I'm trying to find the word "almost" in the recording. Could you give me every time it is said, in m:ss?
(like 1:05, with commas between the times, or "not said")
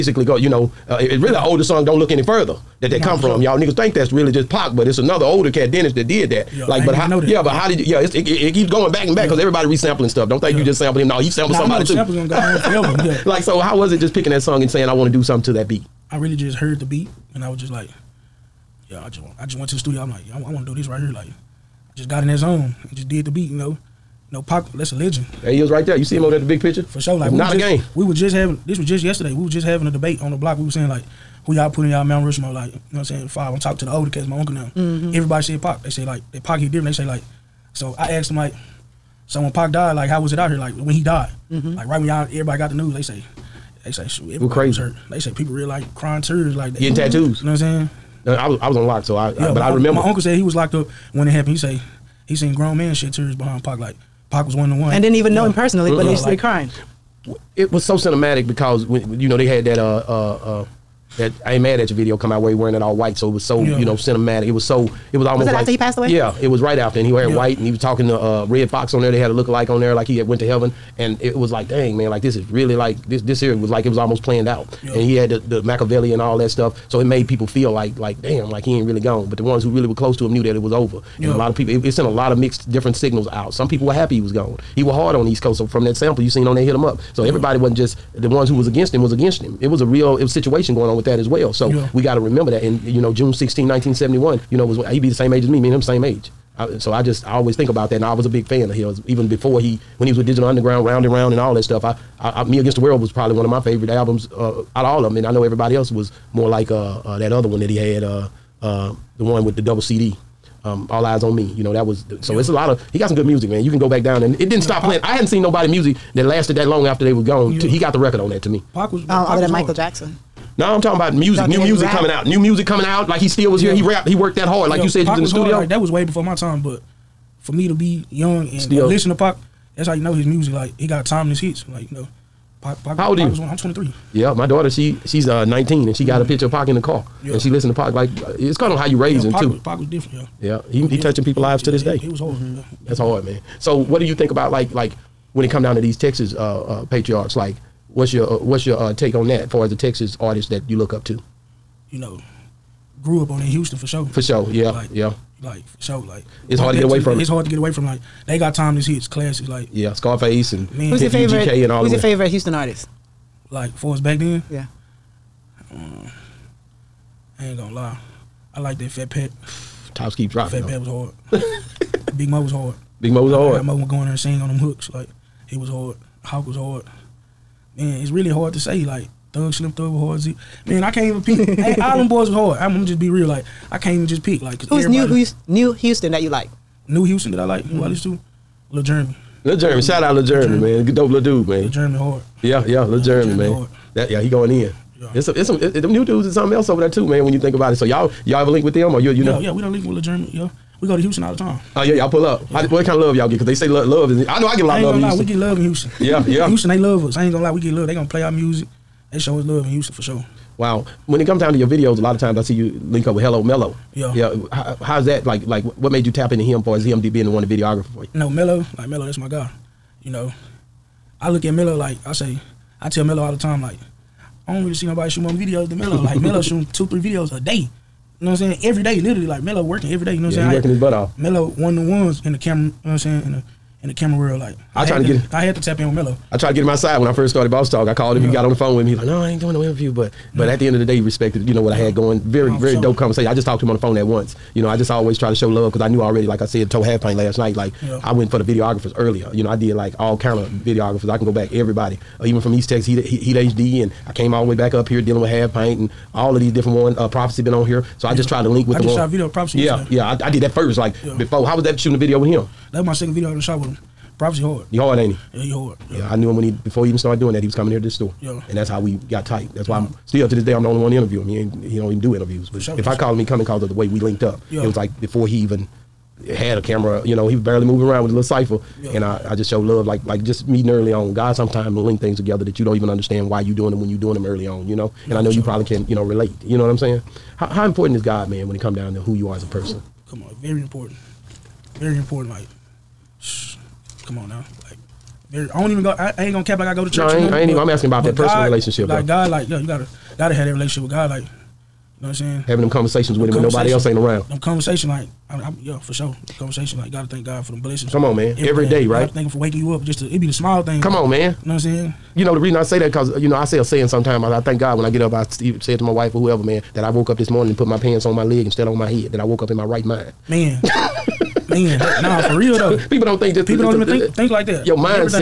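1:05, 1:13.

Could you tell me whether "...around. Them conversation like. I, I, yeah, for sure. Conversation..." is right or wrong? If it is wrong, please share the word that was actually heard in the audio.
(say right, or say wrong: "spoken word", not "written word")
right.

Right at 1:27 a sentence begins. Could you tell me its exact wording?
everybody wasn't just the ones who was against him was against him.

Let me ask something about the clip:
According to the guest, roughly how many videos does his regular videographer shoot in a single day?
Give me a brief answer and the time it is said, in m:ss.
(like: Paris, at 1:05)
2 or 3, at 3:46.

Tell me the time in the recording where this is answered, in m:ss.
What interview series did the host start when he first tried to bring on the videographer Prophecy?
3:57.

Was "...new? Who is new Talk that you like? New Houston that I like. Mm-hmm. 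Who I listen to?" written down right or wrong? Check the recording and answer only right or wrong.
wrong.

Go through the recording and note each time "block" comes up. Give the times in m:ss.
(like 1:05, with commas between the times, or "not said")
0:30.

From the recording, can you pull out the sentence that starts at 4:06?
Like I said, told half paint last night.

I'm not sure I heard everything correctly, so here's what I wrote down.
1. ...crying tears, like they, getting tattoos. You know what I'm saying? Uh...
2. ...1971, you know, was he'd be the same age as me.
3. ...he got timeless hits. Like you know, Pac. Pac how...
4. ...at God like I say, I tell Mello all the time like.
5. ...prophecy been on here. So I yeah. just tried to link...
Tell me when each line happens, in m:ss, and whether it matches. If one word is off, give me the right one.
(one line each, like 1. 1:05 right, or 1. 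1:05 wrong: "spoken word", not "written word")
1. 0:45 right
2. 1:33 right
3. 2:10 right
4. 3:41 wrong: "Mello", not "God"
5. 4:17 right.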